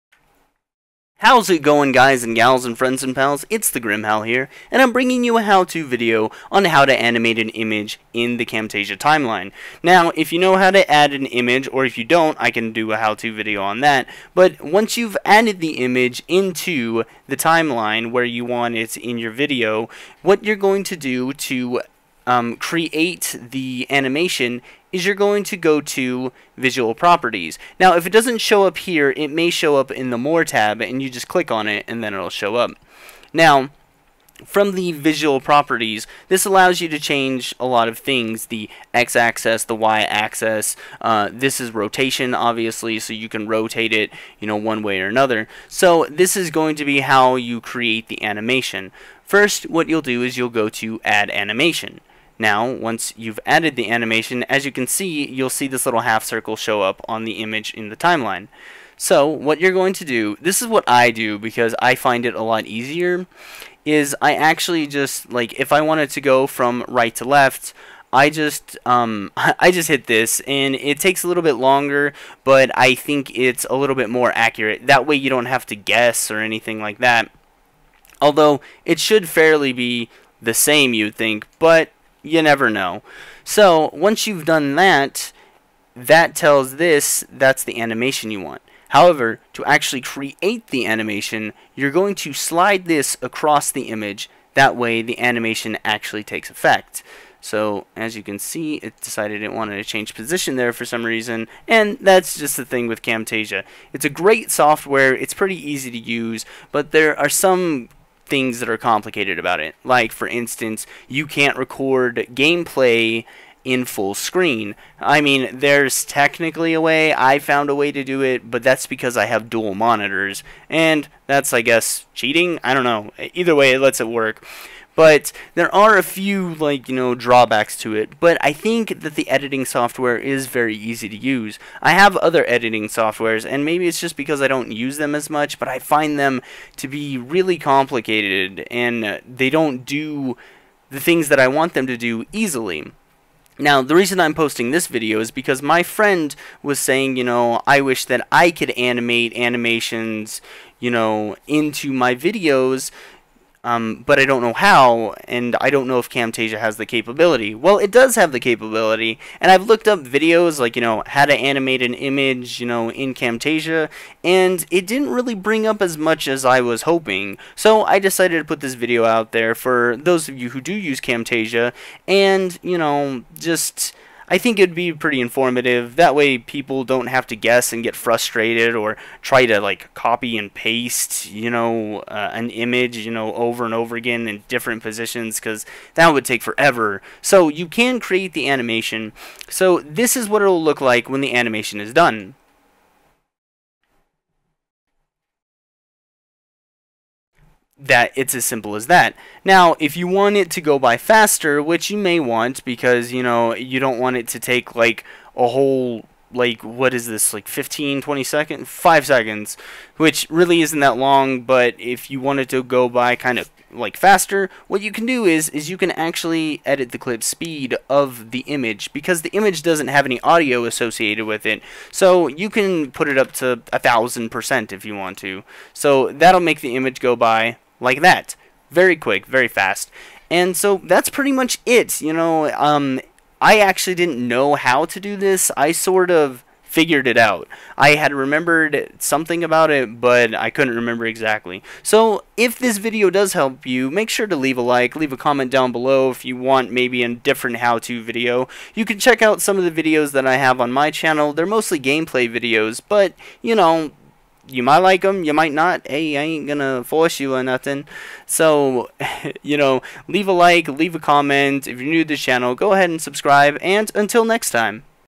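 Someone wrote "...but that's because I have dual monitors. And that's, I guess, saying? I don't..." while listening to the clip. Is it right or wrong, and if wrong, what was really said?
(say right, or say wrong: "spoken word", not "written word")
wrong: "cheating", not "saying".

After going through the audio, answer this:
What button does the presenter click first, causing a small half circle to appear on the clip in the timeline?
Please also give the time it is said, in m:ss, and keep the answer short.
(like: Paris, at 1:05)
Add Animation, at 0:51.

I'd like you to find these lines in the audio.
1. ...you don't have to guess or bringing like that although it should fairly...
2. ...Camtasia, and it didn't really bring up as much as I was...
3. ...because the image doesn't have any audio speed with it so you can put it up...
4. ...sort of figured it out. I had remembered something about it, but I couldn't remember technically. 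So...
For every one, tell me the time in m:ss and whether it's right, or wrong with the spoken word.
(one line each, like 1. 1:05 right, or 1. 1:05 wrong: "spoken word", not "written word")
1. 1:15 wrong: "anything", not "bringing"
2. 2:43 right
3. 3:38 wrong: "associated", not "speed"
4. 3:55 wrong: "exactly", not "technically".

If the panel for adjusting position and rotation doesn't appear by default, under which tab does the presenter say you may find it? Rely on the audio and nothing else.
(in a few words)
More tab.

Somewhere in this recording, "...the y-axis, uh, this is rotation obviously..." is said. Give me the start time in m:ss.
0:39.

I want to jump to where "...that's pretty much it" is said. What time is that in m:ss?
3:50.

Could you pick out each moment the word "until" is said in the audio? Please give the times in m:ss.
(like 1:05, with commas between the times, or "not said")
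4:23.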